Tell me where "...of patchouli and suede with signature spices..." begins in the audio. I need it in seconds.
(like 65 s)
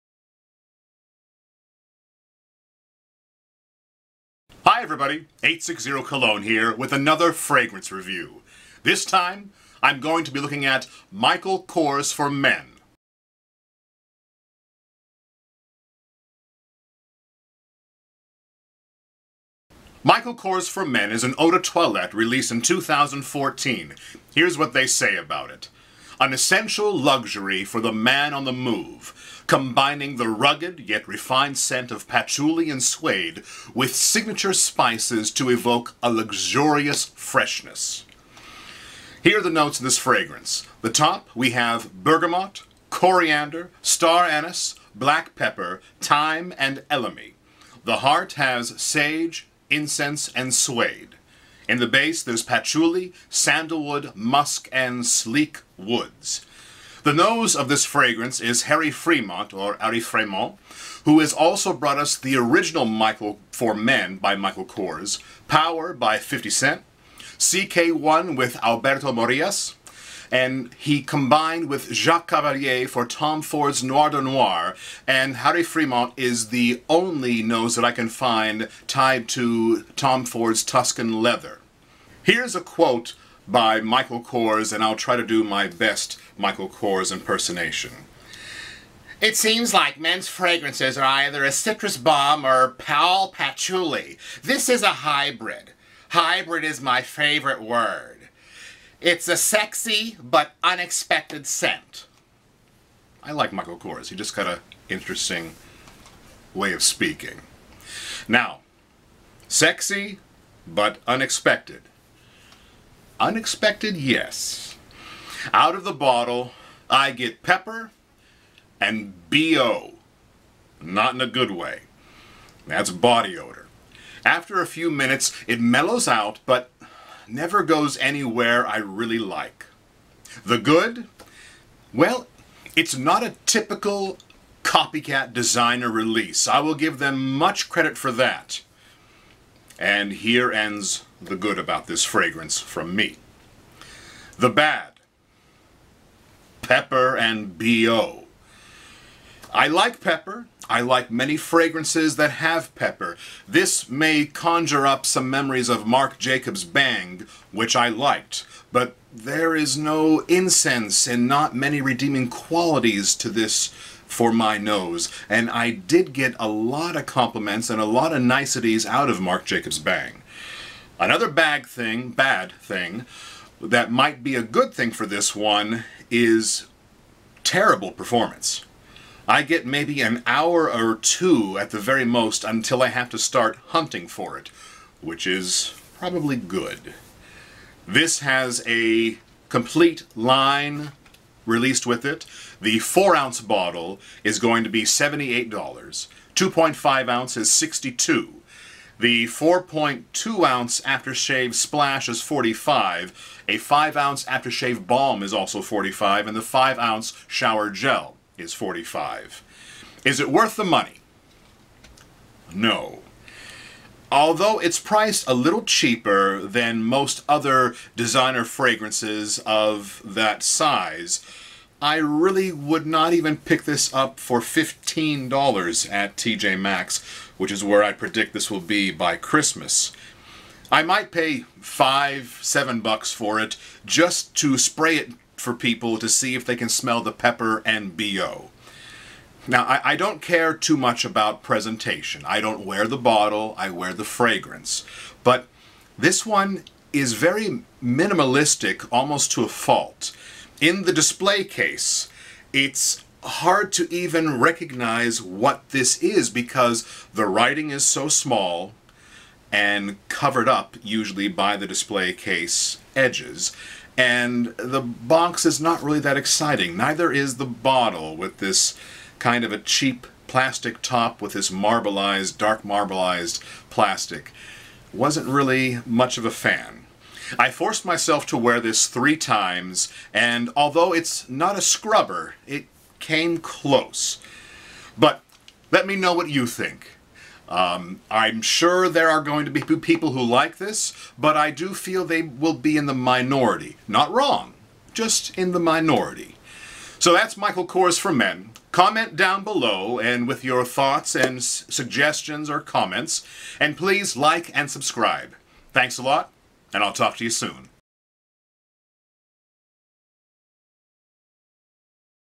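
31 s.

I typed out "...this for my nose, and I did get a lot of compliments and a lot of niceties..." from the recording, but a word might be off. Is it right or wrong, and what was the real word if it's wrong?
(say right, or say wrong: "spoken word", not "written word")
right.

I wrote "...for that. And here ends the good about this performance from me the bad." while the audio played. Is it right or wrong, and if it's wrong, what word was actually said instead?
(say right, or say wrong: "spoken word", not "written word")
wrong: "fragrance", not "performance".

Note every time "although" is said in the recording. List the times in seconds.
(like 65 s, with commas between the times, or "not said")
214 s, 280 s.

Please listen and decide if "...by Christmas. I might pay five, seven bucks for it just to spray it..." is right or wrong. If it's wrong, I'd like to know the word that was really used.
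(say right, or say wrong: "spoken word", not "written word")
right.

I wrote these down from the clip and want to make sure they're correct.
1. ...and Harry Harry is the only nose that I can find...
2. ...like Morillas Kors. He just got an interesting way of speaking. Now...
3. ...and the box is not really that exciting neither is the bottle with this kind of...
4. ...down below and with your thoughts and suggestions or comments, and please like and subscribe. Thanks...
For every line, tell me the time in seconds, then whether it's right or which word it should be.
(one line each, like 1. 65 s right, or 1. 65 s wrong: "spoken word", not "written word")
1. 75 s wrong: "Fremont", not "Harry"
2. 103 s wrong: "Michael", not "Morillas"
3. 263 s right
4. 299 s right.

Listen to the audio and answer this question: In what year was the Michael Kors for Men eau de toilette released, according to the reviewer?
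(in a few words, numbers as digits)
2014.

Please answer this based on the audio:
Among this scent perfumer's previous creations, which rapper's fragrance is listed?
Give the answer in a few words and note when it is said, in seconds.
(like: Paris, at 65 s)
50 Cent, at 66 s.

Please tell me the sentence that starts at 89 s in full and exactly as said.
It seems like men's fragrances are either a citrus bomb or pal patchouli.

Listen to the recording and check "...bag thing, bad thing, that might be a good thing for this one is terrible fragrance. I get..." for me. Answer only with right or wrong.
wrong.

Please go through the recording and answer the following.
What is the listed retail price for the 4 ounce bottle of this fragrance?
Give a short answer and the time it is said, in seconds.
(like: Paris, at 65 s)
$78, at 194 s.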